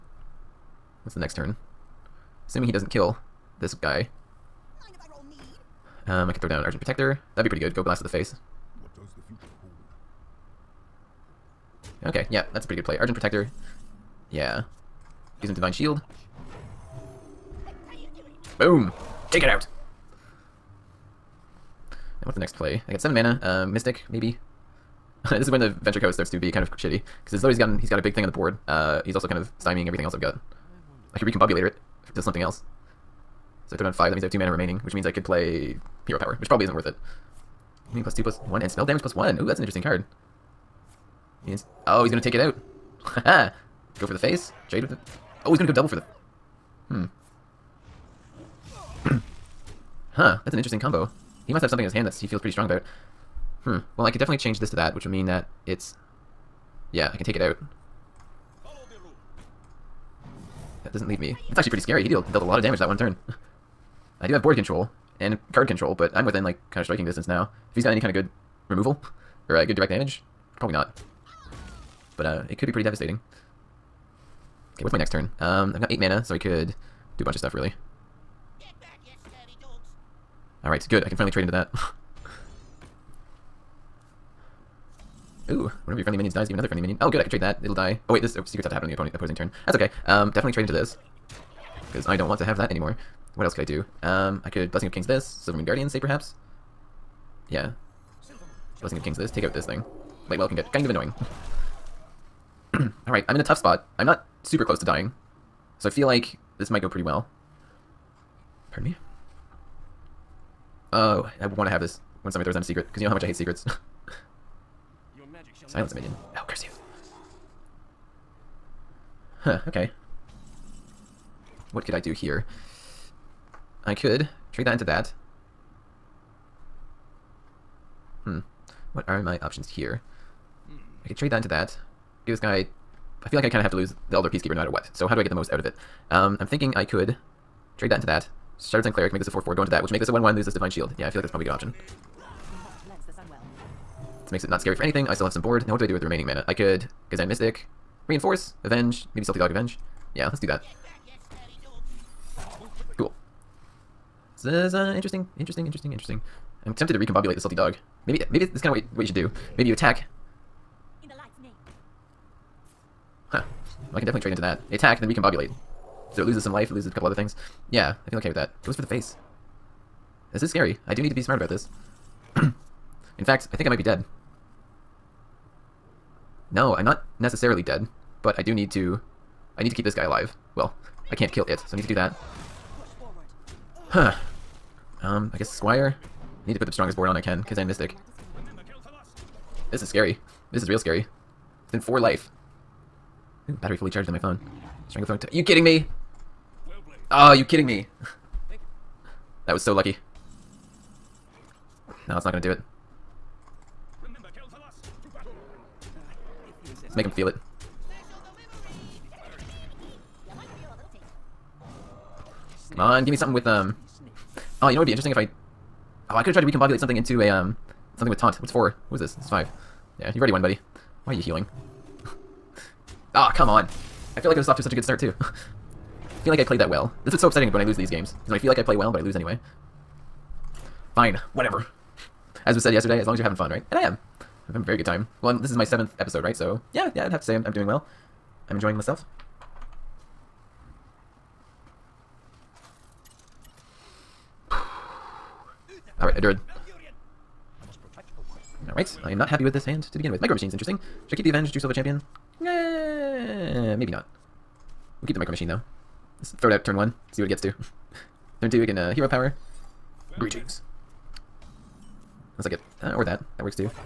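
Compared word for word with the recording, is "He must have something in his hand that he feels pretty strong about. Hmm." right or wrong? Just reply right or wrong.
right.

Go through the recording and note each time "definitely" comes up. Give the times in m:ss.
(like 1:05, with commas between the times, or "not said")
0:54, 1:30, 2:44.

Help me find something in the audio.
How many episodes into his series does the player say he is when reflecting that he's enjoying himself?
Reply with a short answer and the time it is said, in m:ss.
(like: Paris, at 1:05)
7, at 3:55.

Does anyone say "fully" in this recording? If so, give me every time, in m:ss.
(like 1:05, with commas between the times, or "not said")
3:13.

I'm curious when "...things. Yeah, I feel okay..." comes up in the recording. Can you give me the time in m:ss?
2:47.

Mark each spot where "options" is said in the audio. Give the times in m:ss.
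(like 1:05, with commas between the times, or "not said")
2:09, 2:21.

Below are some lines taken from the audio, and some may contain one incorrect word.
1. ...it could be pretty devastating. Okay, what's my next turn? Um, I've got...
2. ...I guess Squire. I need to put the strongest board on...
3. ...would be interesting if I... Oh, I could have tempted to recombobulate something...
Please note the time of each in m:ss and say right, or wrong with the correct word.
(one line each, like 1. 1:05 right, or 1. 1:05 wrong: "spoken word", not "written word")
1. 1:12 right
2. 3:05 right
3. 3:34 wrong: "tried", not "tempted".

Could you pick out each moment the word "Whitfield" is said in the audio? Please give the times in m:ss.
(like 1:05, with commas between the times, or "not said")
not said.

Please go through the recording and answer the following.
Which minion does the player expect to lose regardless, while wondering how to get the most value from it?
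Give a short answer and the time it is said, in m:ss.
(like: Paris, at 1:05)
Aldor Peacekeeper, at 2:14.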